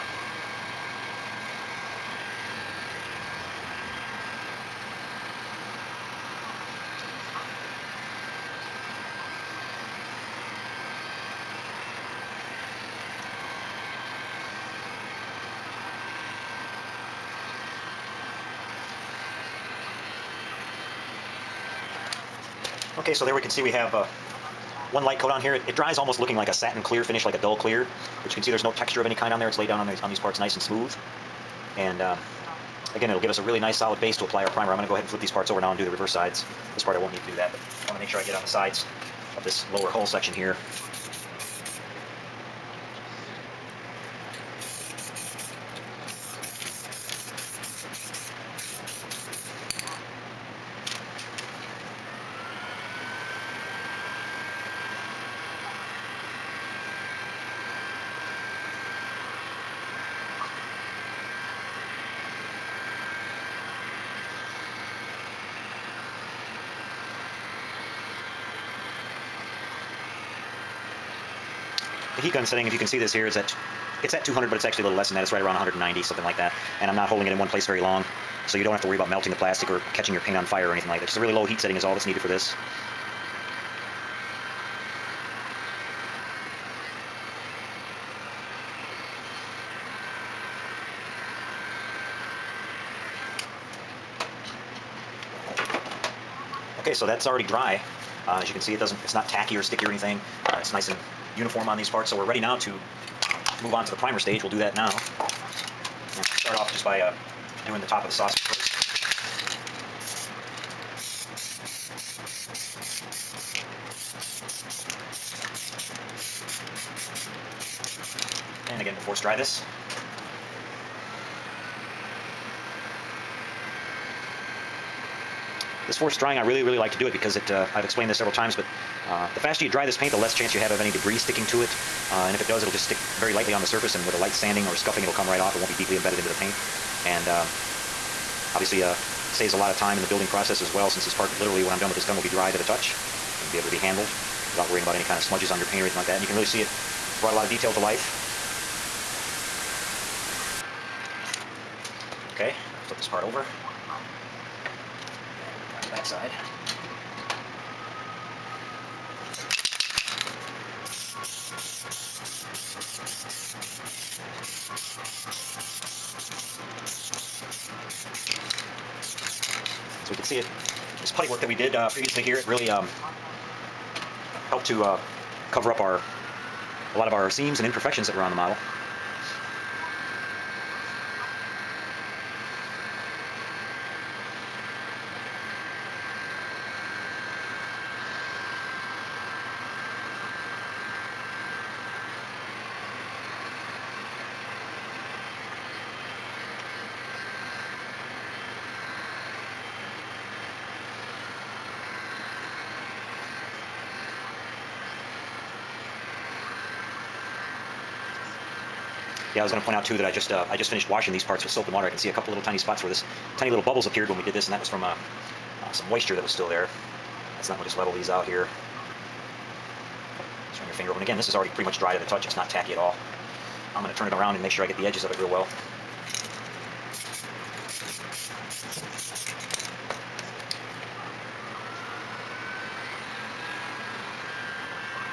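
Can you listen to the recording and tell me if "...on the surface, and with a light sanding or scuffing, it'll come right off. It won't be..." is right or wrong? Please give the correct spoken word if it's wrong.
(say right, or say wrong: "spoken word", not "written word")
right.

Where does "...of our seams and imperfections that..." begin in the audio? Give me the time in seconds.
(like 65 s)
177 s.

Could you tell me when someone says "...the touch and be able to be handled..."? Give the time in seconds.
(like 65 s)
142 s.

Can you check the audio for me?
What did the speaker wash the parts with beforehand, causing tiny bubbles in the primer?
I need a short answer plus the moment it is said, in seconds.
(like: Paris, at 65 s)
Soap and water, at 211 s.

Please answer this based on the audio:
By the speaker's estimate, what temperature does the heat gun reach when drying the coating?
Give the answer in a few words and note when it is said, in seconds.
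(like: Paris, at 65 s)
190, at 75 s.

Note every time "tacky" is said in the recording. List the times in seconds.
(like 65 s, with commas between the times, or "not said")
99 s, 222 s.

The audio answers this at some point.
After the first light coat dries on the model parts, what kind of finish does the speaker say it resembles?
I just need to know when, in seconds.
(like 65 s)
26 s.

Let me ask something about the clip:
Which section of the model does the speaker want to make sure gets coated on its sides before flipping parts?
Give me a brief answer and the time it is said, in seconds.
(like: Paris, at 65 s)
Lower hull section, at 39 s.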